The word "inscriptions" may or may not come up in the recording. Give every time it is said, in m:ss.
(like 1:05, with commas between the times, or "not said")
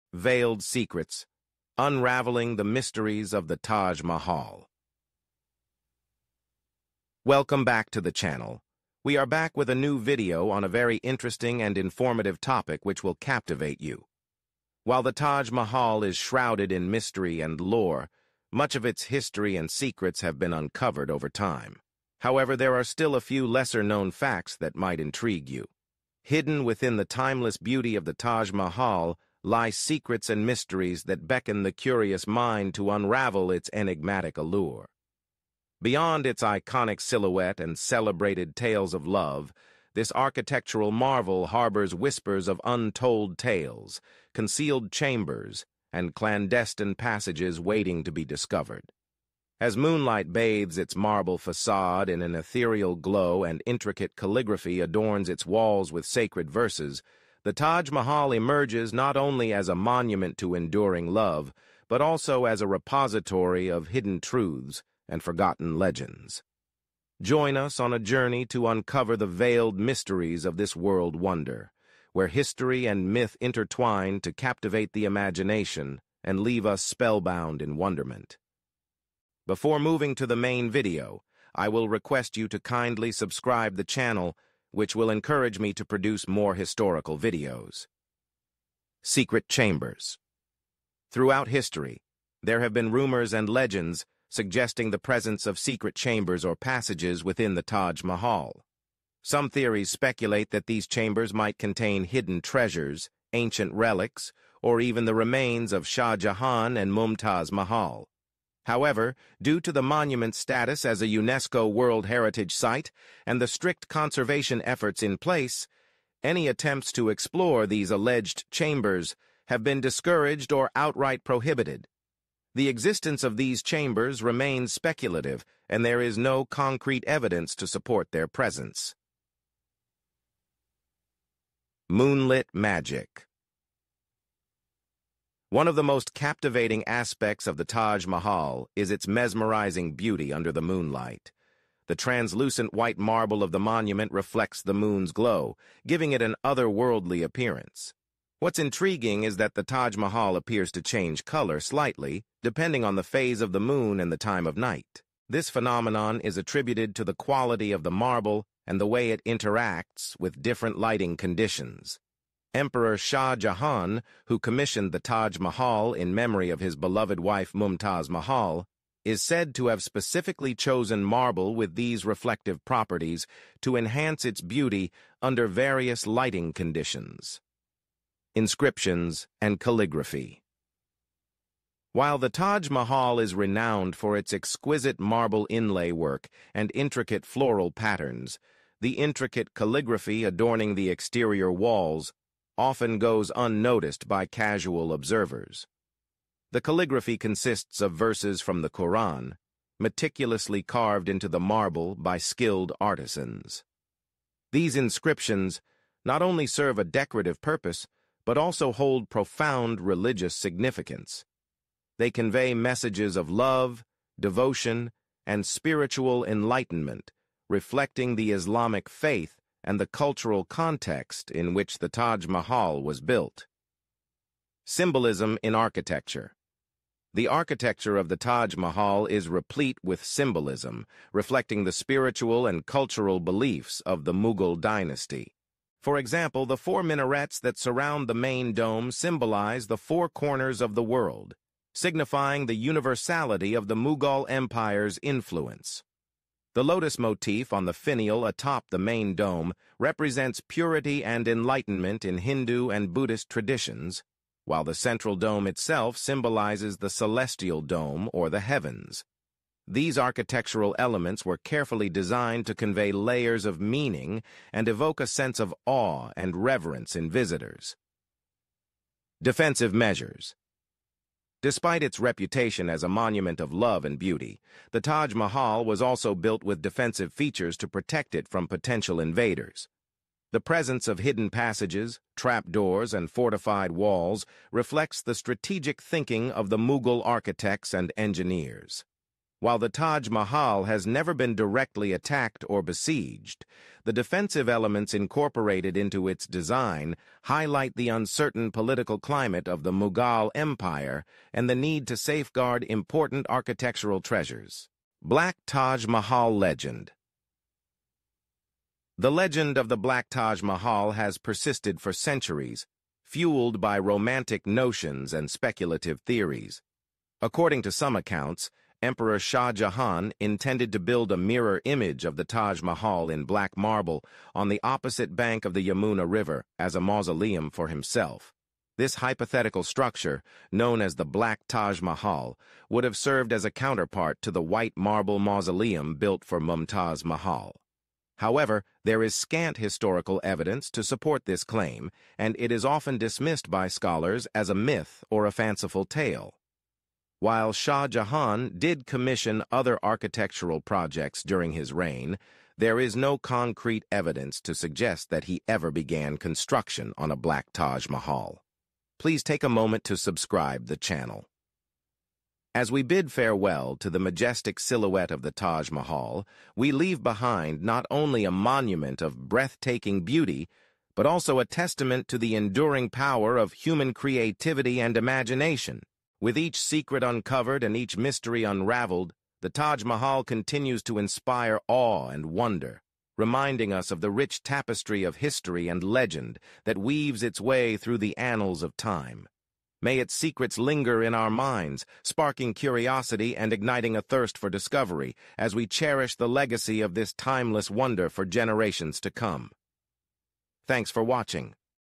2:58, 3:24.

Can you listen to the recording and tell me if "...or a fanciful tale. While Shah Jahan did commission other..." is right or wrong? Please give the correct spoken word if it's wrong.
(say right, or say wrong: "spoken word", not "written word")
right.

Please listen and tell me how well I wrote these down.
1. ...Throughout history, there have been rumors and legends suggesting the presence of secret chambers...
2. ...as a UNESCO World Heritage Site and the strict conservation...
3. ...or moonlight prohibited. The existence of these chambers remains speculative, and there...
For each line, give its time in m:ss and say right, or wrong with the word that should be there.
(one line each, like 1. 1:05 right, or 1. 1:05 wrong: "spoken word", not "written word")
1. 1:31 right
2. 1:50 right
3. 2:00 wrong: "outright", not "moonlight".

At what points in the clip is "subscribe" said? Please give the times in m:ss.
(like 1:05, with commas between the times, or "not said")
1:23, 5:59.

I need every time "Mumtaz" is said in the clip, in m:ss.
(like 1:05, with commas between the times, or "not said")
1:46, 2:47, 5:36.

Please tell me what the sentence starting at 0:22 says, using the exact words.
However, there are still a few lesser-known facts that might intrigue you.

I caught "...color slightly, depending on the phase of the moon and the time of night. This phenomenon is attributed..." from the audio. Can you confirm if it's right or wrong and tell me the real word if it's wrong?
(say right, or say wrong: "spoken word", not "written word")
right.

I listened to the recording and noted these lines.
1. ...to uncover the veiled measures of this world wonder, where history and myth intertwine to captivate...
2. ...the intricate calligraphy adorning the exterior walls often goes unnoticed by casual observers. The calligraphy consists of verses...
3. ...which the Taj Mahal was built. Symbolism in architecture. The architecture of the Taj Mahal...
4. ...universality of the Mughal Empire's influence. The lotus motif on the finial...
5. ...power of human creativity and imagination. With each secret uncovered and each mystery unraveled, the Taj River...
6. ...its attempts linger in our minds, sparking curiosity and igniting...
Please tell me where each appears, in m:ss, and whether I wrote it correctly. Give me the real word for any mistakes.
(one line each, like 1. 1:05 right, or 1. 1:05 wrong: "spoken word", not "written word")
1. 1:08 wrong: "mysteries", not "measures"
2. 3:08 right
3. 3:41 right
4. 4:02 right
5. 6:12 wrong: "Mahal", not "River"
6. 6:29 wrong: "secrets", not "attempts".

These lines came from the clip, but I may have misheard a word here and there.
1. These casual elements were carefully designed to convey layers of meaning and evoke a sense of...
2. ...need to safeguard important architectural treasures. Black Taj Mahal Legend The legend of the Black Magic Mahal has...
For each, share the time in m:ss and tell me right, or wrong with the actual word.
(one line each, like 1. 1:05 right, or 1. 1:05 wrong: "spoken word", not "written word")
1. 4:19 wrong: "architectural", not "casual"
2. 5:01 wrong: "Taj", not "Magic".